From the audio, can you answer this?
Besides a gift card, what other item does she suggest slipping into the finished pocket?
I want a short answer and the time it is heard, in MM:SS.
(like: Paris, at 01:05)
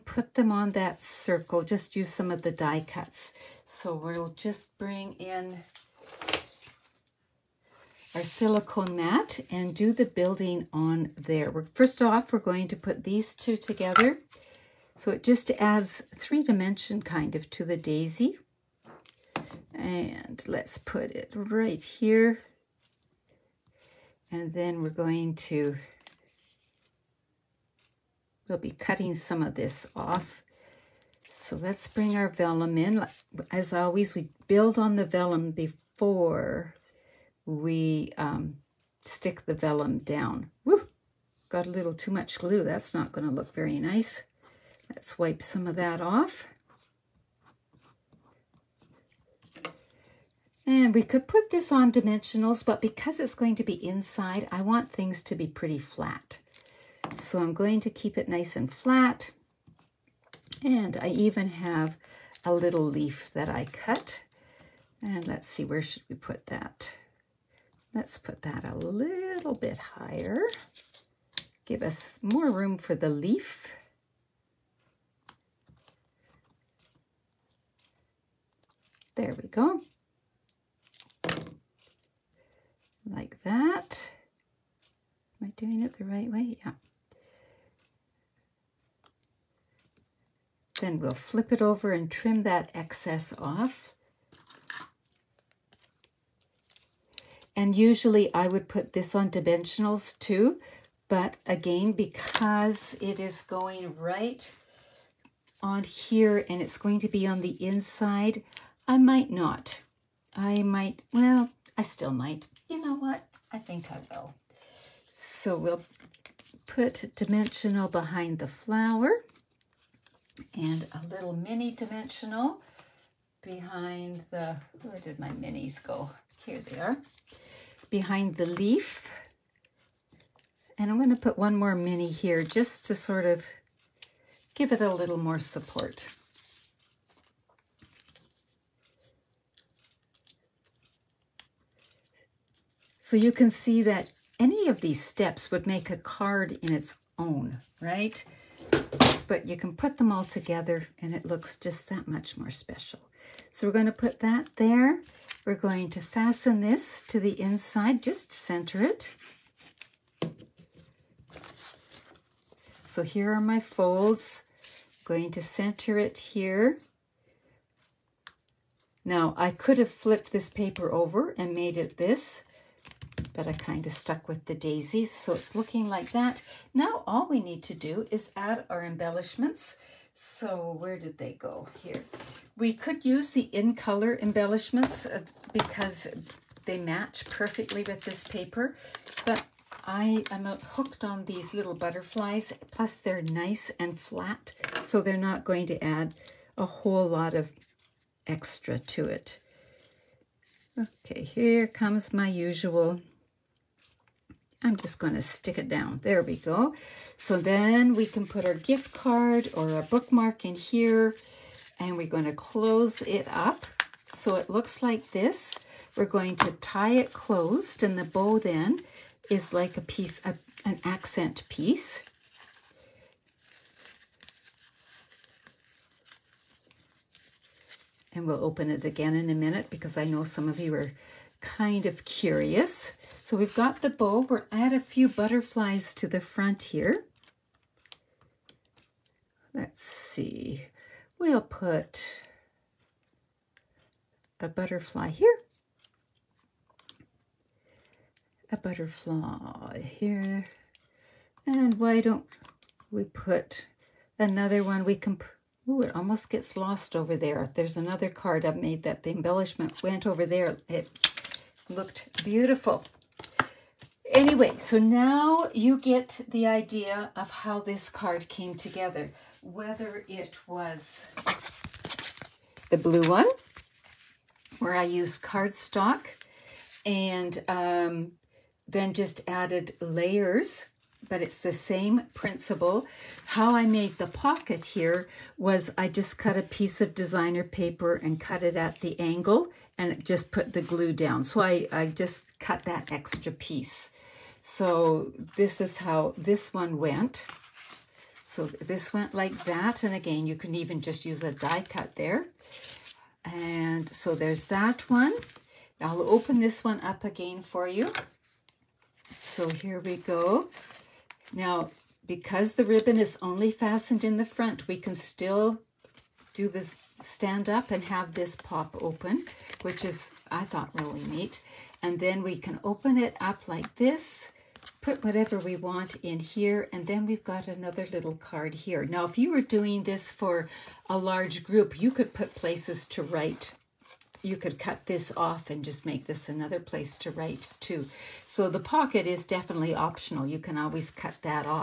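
bookmark, at 03:29.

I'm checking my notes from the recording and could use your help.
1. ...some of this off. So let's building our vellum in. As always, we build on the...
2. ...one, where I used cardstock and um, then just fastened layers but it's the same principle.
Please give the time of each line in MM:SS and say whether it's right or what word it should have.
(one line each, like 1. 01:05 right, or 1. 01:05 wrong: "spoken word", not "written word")
1. 00:29 wrong: "bring", not "building"
2. 04:33 wrong: "added", not "fastened".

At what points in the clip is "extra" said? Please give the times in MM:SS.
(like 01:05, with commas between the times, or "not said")
03:18, 04:52.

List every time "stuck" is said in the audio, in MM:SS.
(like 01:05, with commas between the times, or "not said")
02:53.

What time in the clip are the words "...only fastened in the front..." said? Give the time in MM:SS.
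05:13.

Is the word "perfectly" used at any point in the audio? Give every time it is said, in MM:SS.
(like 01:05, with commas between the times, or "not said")
03:07.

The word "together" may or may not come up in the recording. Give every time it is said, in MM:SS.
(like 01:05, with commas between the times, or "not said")
00:13, 02:30, 04:28.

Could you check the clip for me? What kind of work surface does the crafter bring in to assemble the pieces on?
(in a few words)
silicone mat.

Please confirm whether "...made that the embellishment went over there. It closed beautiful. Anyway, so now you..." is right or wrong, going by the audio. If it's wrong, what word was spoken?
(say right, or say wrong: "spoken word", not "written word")
wrong: "looked", not "closed".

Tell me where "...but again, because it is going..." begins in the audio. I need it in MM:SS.
01:41.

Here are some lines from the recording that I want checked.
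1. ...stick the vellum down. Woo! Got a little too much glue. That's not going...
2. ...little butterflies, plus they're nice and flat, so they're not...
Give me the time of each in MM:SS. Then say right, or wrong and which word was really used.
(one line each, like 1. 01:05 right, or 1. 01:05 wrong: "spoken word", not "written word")
1. 00:39 right
2. 03:11 right.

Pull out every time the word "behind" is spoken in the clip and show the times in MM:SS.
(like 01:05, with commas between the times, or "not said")
01:57, 02:03, 02:07.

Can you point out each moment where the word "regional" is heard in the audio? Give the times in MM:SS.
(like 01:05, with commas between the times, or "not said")
not said.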